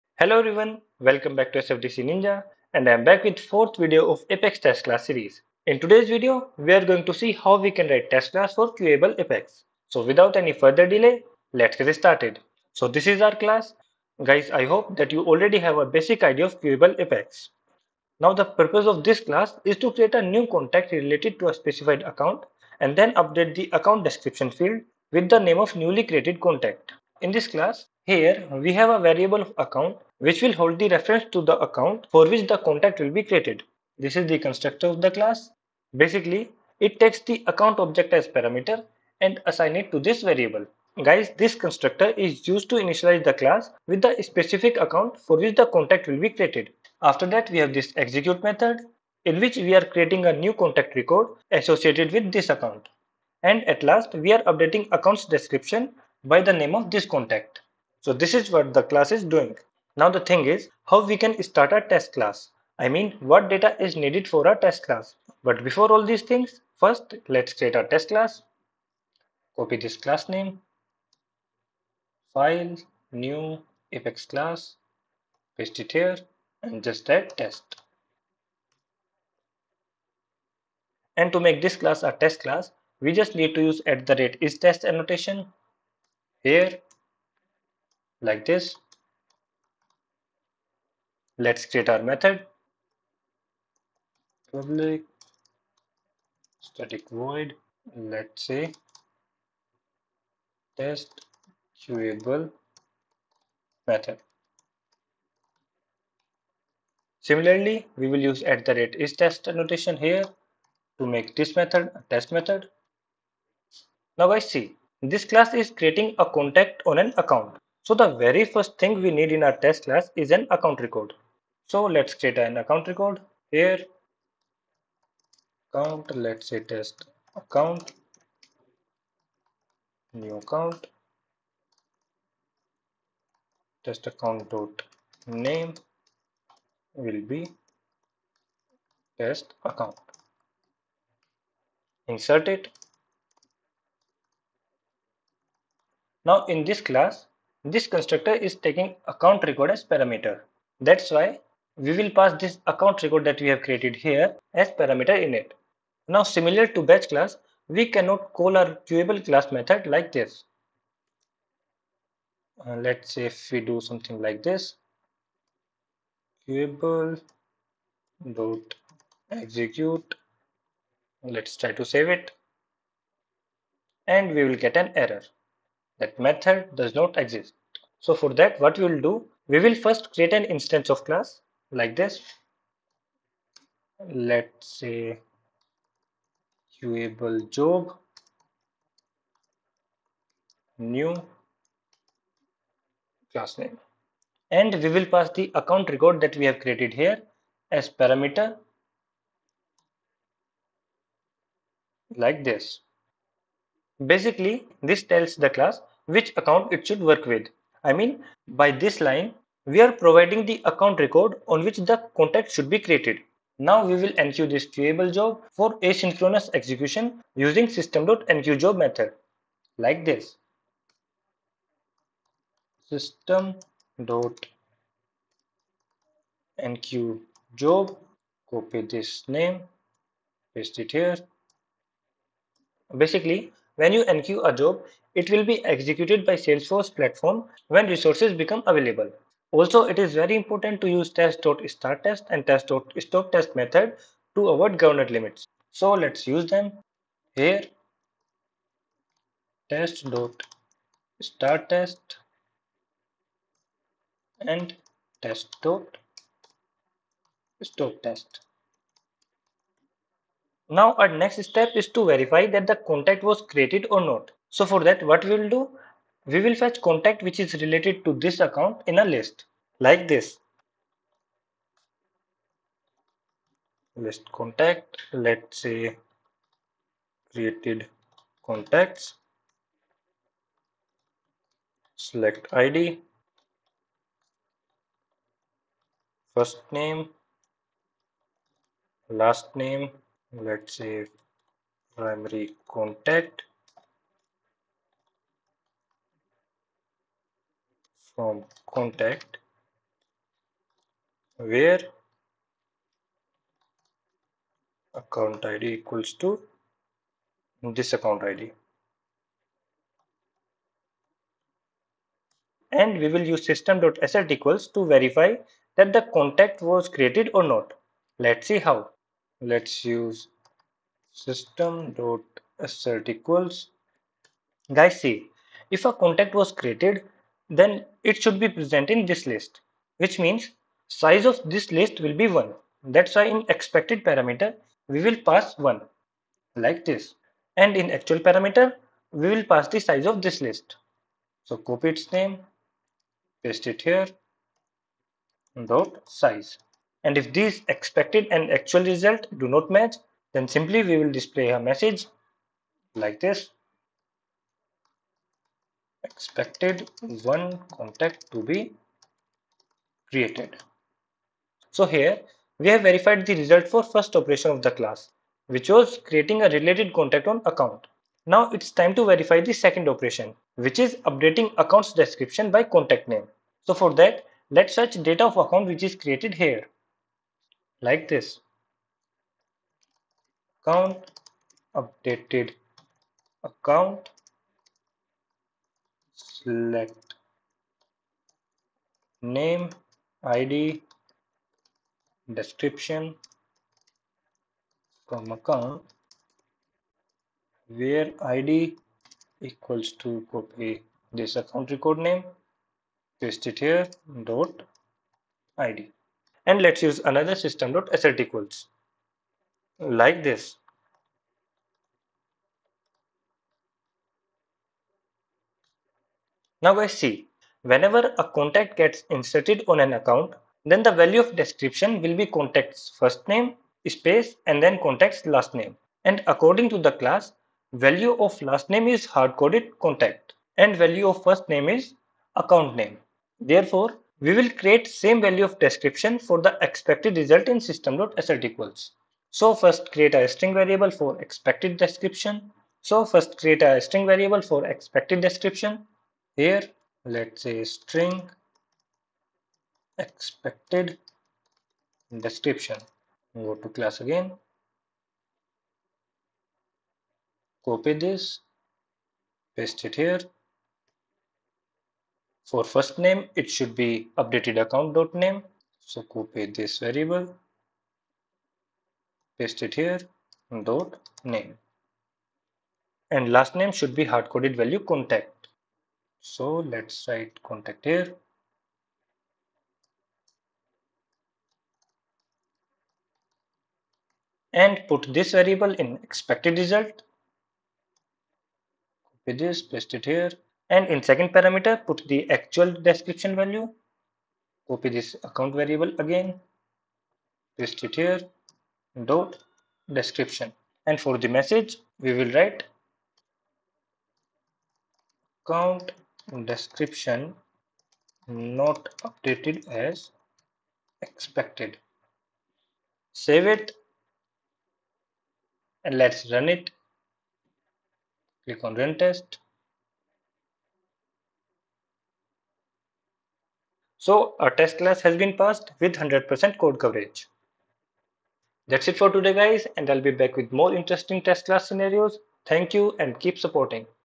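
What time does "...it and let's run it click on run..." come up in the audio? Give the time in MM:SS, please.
08:33.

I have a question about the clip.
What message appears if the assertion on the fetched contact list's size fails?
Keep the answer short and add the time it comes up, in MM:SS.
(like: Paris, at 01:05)
Expected one contact to be created, at 05:56.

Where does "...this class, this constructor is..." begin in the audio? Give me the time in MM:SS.
02:26.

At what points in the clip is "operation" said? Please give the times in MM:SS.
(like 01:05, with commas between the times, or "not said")
06:04, 06:09.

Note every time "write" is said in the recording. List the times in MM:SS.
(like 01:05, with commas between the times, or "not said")
00:07, 07:57, 08:22.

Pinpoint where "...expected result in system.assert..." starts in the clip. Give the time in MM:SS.
07:16.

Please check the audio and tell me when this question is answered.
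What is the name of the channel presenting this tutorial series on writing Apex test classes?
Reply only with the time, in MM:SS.
00:01.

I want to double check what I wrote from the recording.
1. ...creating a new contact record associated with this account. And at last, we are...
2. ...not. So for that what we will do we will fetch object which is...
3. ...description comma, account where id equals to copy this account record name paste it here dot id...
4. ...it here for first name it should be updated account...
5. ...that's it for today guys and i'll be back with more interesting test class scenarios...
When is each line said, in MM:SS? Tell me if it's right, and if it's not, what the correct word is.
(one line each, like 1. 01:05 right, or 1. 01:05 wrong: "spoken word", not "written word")
1. 00:49 right
2. 04:24 wrong: "contact", not "object"
3. 06:32 right
4. 07:39 right
5. 08:48 right.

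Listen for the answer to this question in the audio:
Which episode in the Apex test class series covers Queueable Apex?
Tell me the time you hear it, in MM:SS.
00:03.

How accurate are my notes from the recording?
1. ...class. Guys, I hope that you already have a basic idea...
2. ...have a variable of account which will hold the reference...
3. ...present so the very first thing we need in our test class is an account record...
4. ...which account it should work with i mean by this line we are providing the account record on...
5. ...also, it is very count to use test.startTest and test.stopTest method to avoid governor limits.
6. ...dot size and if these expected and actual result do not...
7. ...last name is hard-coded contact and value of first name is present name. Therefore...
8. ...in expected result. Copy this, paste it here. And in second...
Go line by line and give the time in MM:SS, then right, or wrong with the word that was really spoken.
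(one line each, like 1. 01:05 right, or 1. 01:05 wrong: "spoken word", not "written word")
1. 00:13 right
2. 00:28 right
3. 01:57 wrong: "account", not "present"
4. 03:26 right
5. 03:59 wrong: "important", not "count"
6. 05:45 right
7. 07:08 wrong: "account", not "present"
8. 08:05 right.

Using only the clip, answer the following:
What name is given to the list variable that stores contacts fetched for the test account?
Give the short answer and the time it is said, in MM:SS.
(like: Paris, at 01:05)
created contacts, at 04:37.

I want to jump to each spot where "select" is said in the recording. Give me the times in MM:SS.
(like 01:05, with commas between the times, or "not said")
04:41, 06:26.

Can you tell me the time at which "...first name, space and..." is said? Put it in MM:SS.
07:02.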